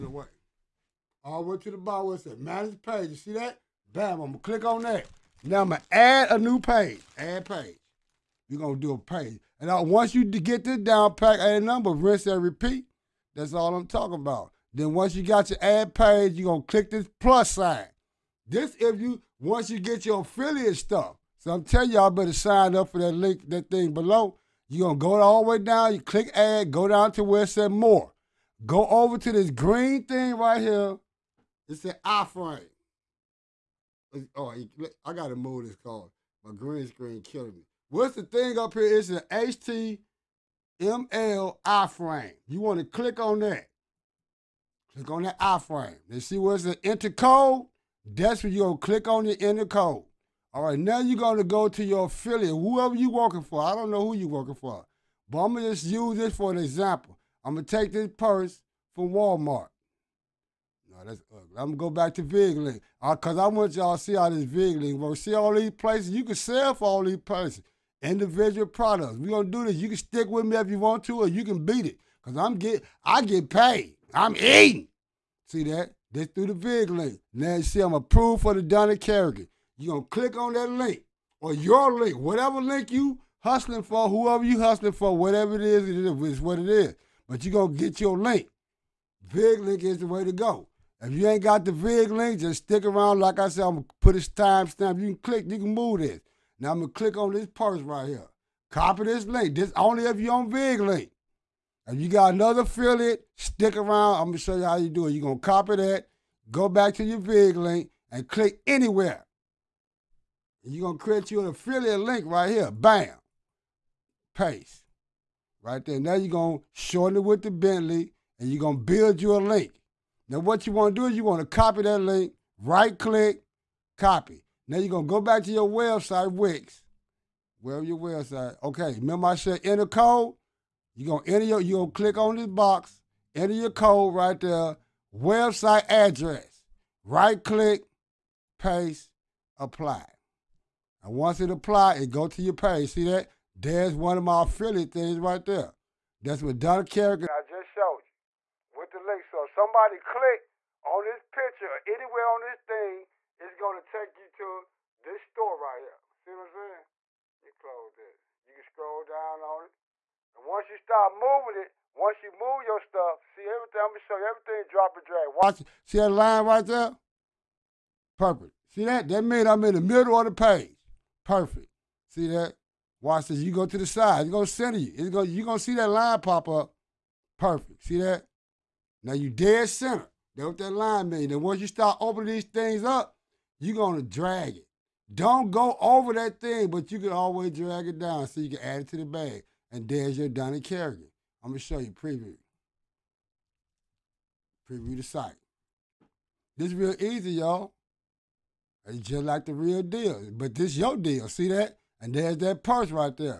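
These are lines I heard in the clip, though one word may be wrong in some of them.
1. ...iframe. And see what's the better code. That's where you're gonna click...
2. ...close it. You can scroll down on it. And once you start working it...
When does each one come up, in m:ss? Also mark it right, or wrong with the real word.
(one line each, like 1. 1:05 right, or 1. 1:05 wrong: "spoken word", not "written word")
1. 0:45 wrong: "enter", not "better"
2. 2:37 wrong: "moving", not "working".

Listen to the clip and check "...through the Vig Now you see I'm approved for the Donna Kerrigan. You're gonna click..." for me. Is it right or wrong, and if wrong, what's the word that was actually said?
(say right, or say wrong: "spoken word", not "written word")
right.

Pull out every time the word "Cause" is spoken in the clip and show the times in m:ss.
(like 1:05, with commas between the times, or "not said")
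1:03, 1:12.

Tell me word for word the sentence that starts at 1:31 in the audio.
If you ain't got the VIG link, just stick around.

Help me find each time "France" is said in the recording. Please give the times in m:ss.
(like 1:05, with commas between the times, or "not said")
not said.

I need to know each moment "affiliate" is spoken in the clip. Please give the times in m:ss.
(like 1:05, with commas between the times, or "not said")
0:20, 0:52, 1:42, 1:51, 2:24.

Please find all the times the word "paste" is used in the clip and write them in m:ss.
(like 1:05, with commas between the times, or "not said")
1:54, 2:18.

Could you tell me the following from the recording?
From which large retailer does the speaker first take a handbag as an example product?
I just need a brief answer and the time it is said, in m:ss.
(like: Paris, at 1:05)
Walmart, at 0:57.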